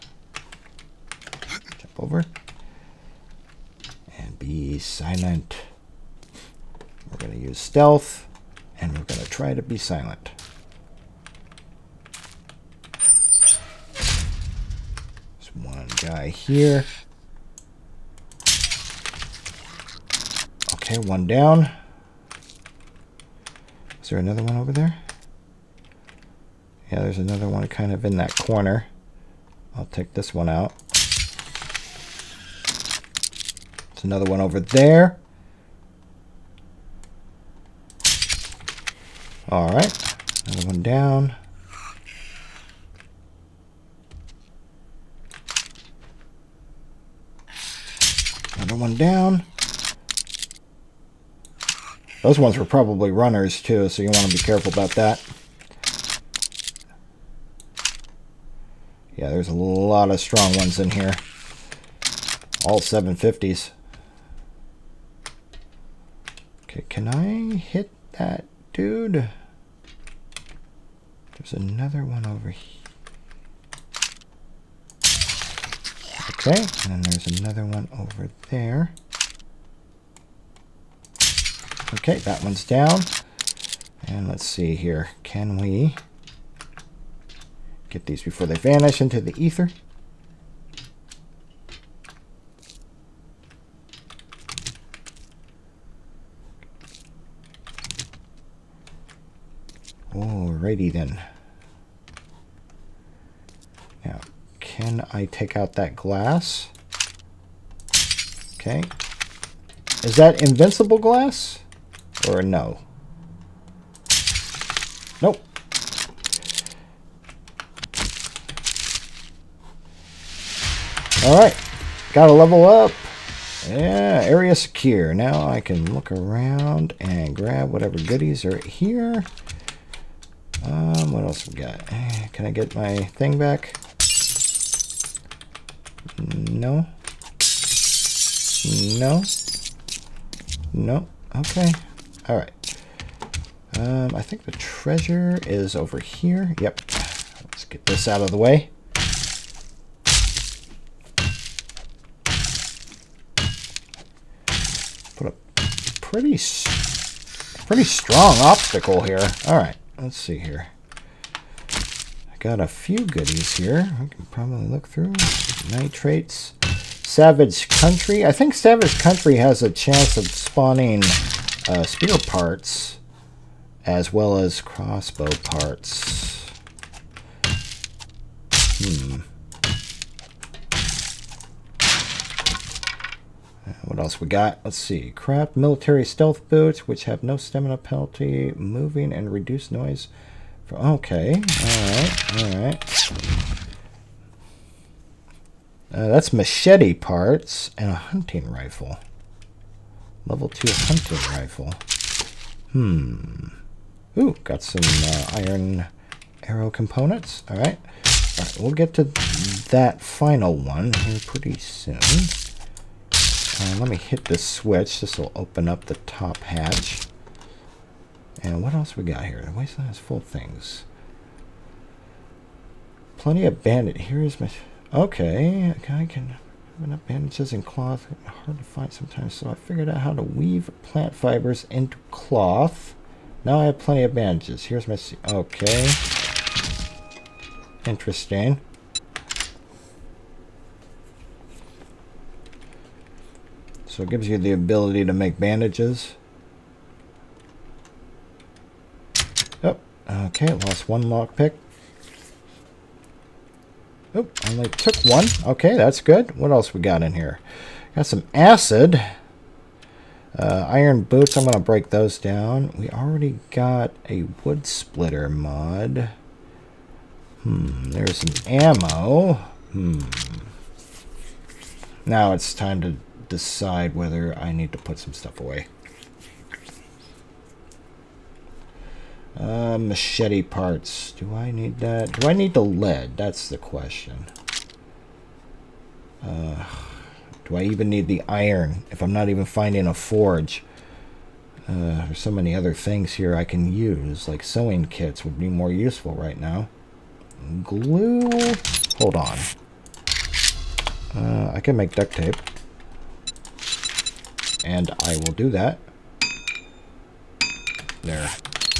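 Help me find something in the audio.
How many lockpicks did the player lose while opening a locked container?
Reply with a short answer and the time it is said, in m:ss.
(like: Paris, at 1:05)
1, at 4:10.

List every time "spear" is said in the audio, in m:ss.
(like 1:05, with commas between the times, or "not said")
2:51.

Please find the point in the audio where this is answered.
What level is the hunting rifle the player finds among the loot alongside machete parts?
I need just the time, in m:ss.
3:20.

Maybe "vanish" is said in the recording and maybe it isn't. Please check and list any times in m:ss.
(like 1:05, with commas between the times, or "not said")
1:28.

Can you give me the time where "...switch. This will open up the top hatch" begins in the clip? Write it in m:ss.
3:34.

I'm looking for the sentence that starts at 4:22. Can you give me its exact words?
We already got a wood splitter mod.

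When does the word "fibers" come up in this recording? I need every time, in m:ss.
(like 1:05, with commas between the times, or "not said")
3:51.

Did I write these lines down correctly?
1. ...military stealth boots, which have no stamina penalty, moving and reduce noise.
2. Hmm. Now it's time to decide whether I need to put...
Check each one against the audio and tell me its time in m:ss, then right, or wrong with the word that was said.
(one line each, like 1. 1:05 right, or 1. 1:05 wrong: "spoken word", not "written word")
1. 3:05 right
2. 4:29 right.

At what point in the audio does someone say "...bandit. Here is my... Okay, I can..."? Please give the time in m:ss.
3:43.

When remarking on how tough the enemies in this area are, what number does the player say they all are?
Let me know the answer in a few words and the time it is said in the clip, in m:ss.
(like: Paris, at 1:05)
750, at 1:02.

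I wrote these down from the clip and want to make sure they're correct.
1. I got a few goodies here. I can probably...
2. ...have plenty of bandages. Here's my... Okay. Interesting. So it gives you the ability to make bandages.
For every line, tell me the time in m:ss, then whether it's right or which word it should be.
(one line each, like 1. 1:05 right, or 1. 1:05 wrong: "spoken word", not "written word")
1. 2:41 right
2. 3:53 right.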